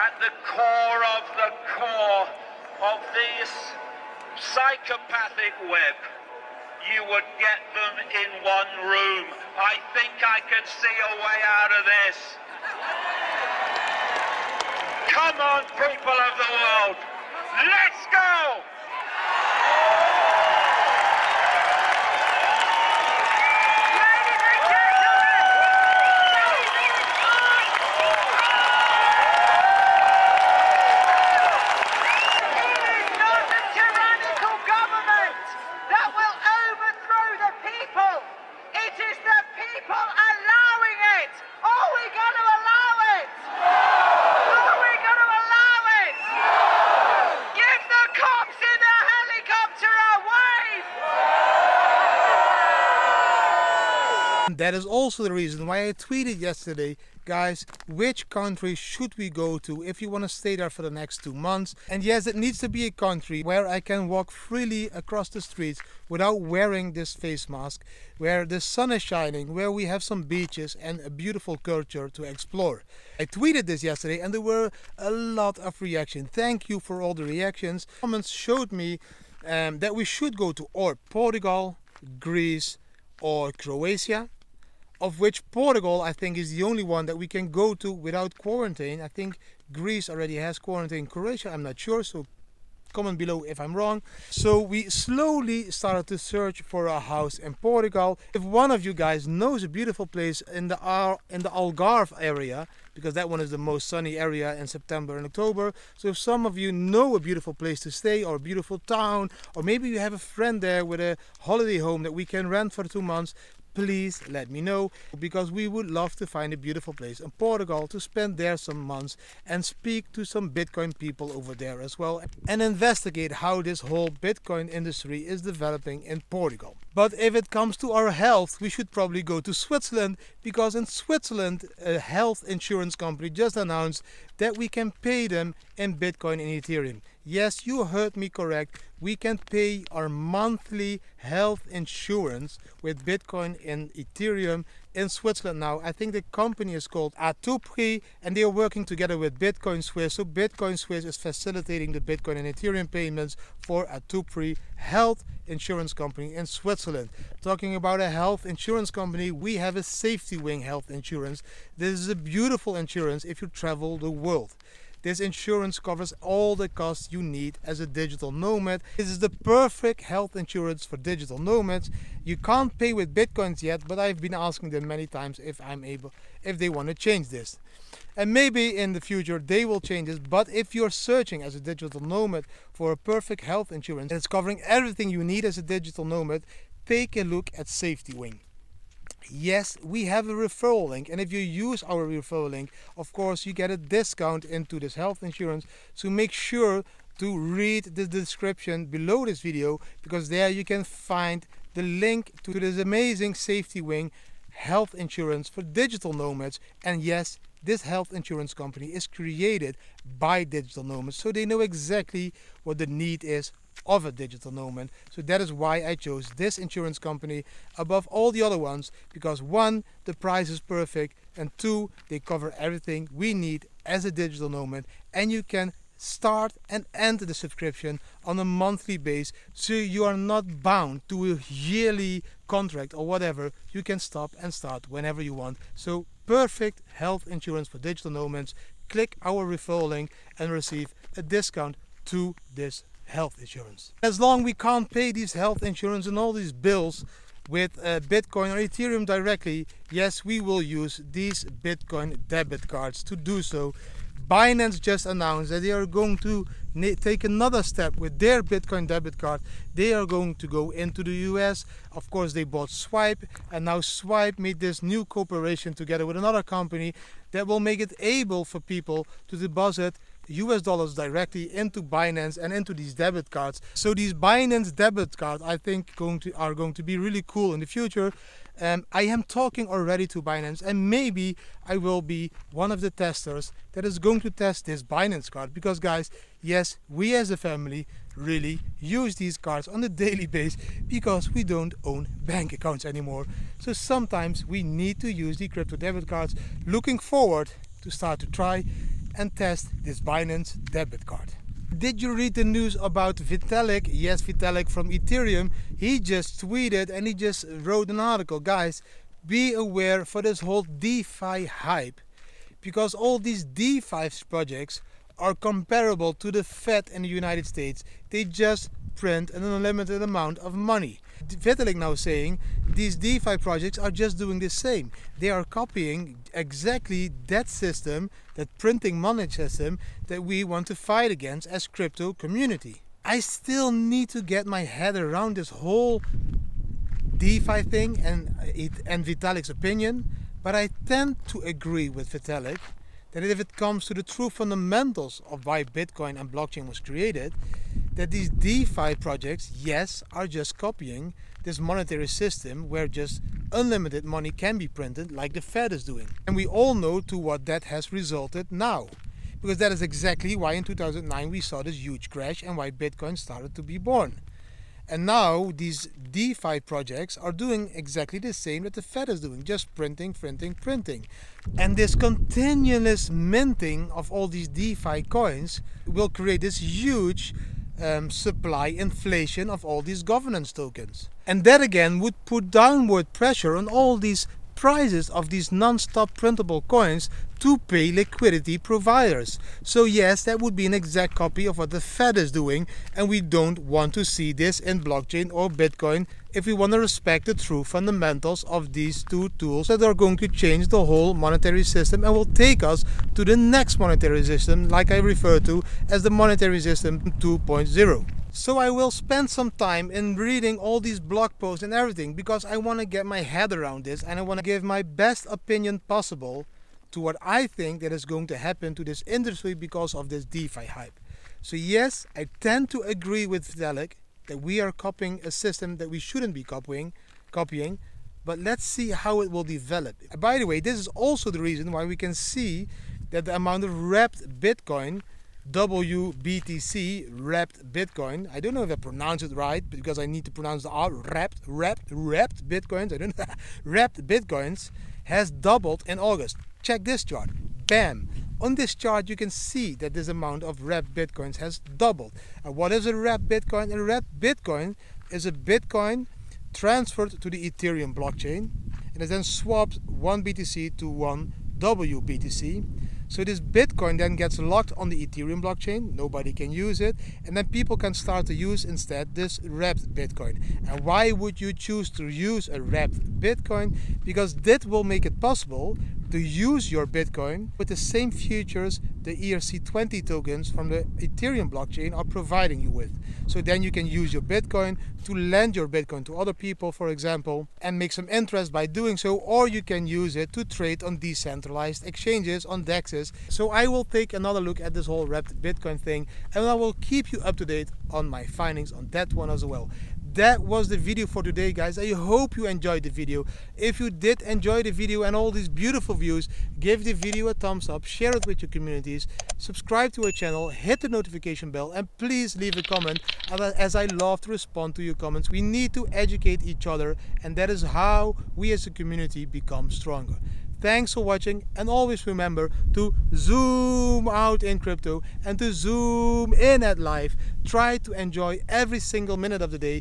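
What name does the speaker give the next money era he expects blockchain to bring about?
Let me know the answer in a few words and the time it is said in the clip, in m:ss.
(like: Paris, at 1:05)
monetary system 2.0, at 6:46.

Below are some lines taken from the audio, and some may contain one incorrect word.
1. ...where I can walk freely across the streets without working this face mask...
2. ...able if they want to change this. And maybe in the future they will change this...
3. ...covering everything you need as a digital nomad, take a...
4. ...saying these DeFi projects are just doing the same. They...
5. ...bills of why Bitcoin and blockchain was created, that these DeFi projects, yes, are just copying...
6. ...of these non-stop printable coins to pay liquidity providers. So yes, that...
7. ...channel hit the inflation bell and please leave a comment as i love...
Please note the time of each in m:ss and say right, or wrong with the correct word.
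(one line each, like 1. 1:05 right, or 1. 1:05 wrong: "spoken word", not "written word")
1. 1:03 wrong: "wearing", not "working"
2. 2:55 right
3. 3:04 right
4. 5:21 right
5. 5:44 wrong: "fundamentals", not "bills"
6. 6:25 right
7. 8:30 wrong: "notification", not "inflation".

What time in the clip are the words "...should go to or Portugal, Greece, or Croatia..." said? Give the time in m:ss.
1:20.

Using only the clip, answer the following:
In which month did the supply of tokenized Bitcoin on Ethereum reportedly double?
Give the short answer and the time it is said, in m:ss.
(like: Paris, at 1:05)
August, at 7:25.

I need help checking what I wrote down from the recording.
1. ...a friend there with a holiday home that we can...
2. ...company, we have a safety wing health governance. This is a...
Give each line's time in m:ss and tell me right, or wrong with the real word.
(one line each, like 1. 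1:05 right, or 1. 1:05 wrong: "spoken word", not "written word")
1. 1:50 right
2. 2:38 wrong: "insurance", not "governance".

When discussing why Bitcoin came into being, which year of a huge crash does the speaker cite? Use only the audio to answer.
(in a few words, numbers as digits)
2009.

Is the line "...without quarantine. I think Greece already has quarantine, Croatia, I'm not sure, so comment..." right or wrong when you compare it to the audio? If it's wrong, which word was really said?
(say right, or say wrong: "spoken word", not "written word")
right.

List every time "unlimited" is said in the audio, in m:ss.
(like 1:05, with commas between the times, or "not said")
5:19, 5:53.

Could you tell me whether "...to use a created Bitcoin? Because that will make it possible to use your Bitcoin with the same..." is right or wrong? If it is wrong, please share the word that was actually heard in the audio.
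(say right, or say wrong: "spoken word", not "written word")
wrong: "wrapped", not "created".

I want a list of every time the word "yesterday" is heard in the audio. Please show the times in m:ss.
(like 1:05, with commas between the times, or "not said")
0:56, 1:13.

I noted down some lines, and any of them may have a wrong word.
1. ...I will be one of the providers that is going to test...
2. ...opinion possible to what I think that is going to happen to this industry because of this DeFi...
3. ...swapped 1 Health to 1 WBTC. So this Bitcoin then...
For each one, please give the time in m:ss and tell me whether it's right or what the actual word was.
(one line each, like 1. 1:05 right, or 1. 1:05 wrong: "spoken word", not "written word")
1. 4:41 wrong: "testers", not "providers"
2. 6:55 right
3. 7:39 wrong: "BTC", not "Health".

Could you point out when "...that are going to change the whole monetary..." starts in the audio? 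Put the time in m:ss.
6:39.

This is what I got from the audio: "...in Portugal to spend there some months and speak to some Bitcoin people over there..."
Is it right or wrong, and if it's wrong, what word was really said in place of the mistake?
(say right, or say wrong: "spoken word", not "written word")
right.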